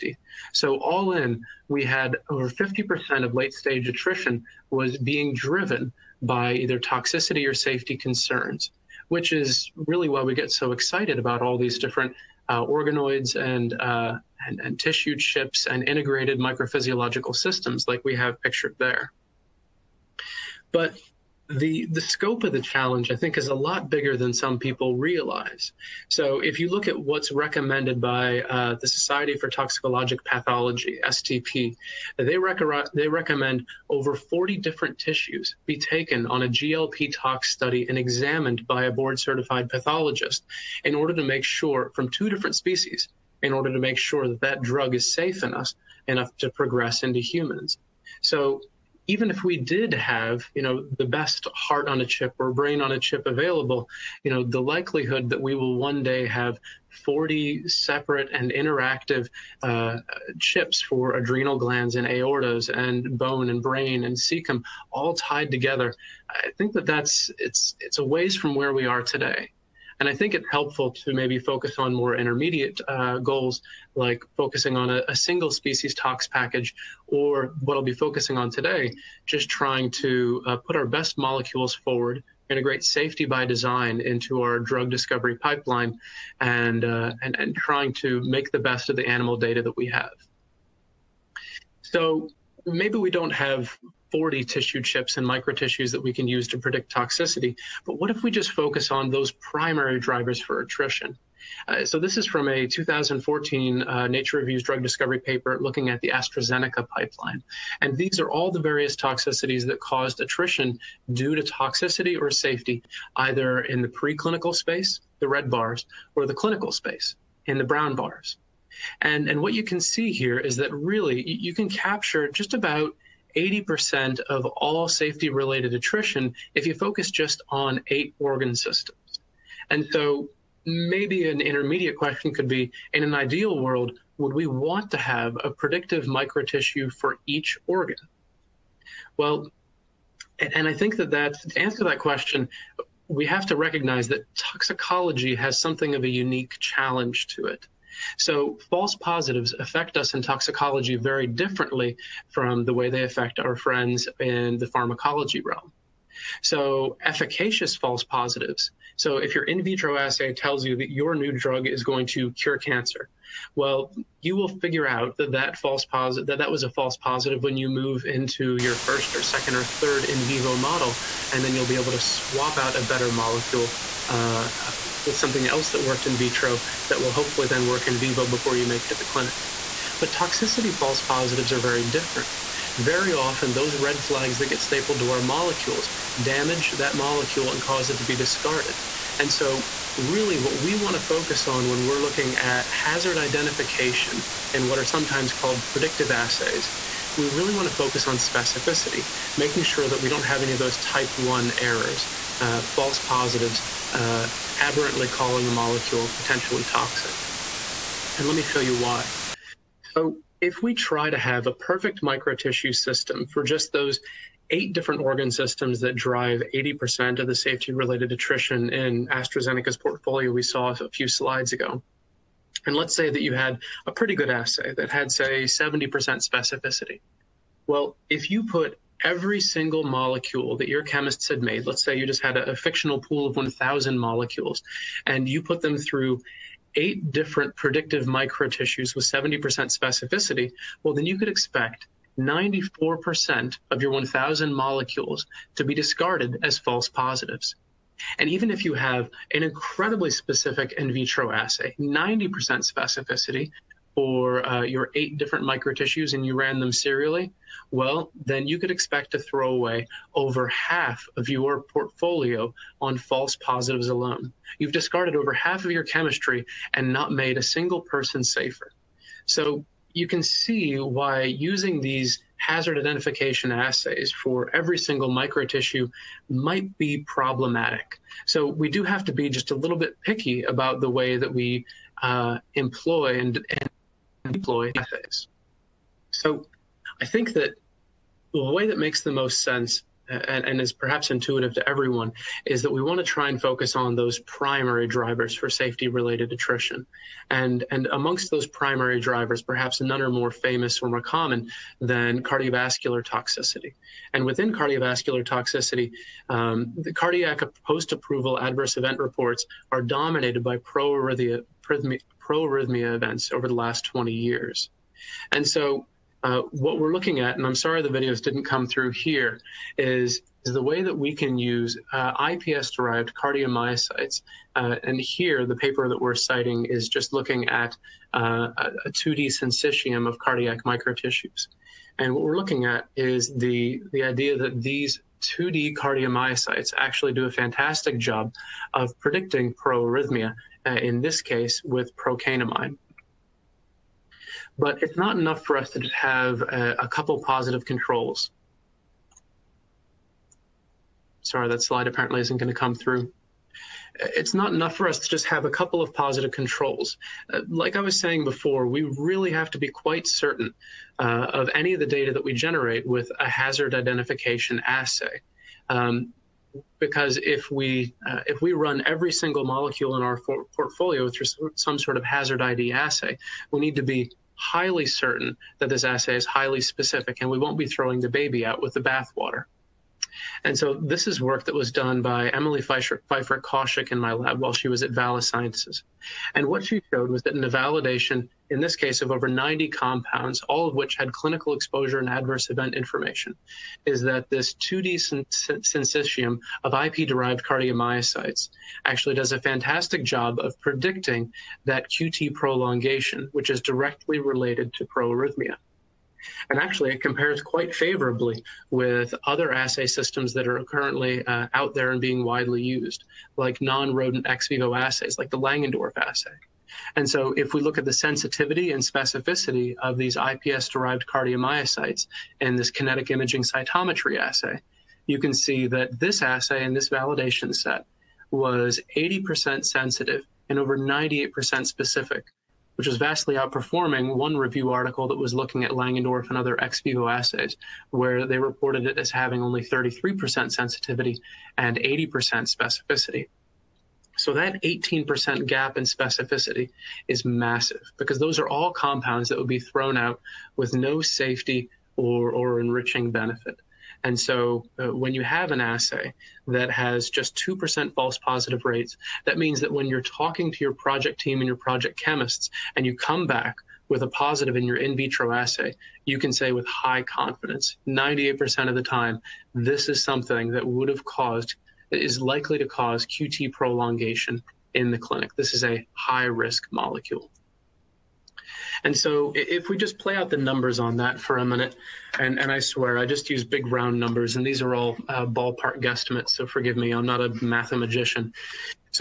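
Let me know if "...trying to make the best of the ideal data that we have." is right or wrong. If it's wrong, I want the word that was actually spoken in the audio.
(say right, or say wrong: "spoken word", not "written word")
wrong: "animal", not "ideal".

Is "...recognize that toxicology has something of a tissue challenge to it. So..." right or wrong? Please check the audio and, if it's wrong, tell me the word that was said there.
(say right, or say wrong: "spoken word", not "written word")
wrong: "unique", not "tissue".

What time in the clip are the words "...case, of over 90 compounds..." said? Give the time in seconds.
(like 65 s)
388 s.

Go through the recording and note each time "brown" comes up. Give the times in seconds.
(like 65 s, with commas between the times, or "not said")
117 s.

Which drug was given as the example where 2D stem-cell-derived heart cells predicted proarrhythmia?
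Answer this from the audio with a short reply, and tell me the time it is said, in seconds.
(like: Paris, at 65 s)
procainamide, at 341 s.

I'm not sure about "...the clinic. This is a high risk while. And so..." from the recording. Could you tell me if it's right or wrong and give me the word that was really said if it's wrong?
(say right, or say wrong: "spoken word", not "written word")
wrong: "molecule", not "while".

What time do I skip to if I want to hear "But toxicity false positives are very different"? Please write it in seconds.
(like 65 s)
179 s.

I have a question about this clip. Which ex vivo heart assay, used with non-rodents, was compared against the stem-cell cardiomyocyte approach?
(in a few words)
Langendorff assay.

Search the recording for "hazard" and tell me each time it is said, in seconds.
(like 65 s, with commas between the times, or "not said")
192 s, 272 s, 363 s, 372 s.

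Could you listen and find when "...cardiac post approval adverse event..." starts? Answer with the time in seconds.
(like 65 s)
306 s.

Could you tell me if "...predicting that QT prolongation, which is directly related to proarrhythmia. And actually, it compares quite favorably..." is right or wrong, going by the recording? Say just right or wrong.
right.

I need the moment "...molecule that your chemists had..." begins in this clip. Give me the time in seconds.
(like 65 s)
229 s.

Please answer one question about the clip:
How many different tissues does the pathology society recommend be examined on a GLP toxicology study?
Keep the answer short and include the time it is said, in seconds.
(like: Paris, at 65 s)
over 40, at 33 s.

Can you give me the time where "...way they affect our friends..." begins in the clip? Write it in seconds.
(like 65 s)
152 s.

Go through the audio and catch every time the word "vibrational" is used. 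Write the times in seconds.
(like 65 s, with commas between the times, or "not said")
not said.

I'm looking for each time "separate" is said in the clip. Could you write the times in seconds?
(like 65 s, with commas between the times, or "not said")
57 s.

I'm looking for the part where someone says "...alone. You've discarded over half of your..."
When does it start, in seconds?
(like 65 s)
263 s.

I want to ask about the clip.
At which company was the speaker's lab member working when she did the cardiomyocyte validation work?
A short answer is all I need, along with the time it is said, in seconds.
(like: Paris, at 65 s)
Vala Sciences, at 384 s.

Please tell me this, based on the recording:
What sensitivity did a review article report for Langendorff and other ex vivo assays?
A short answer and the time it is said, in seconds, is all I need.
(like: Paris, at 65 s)
33%, at 439 s.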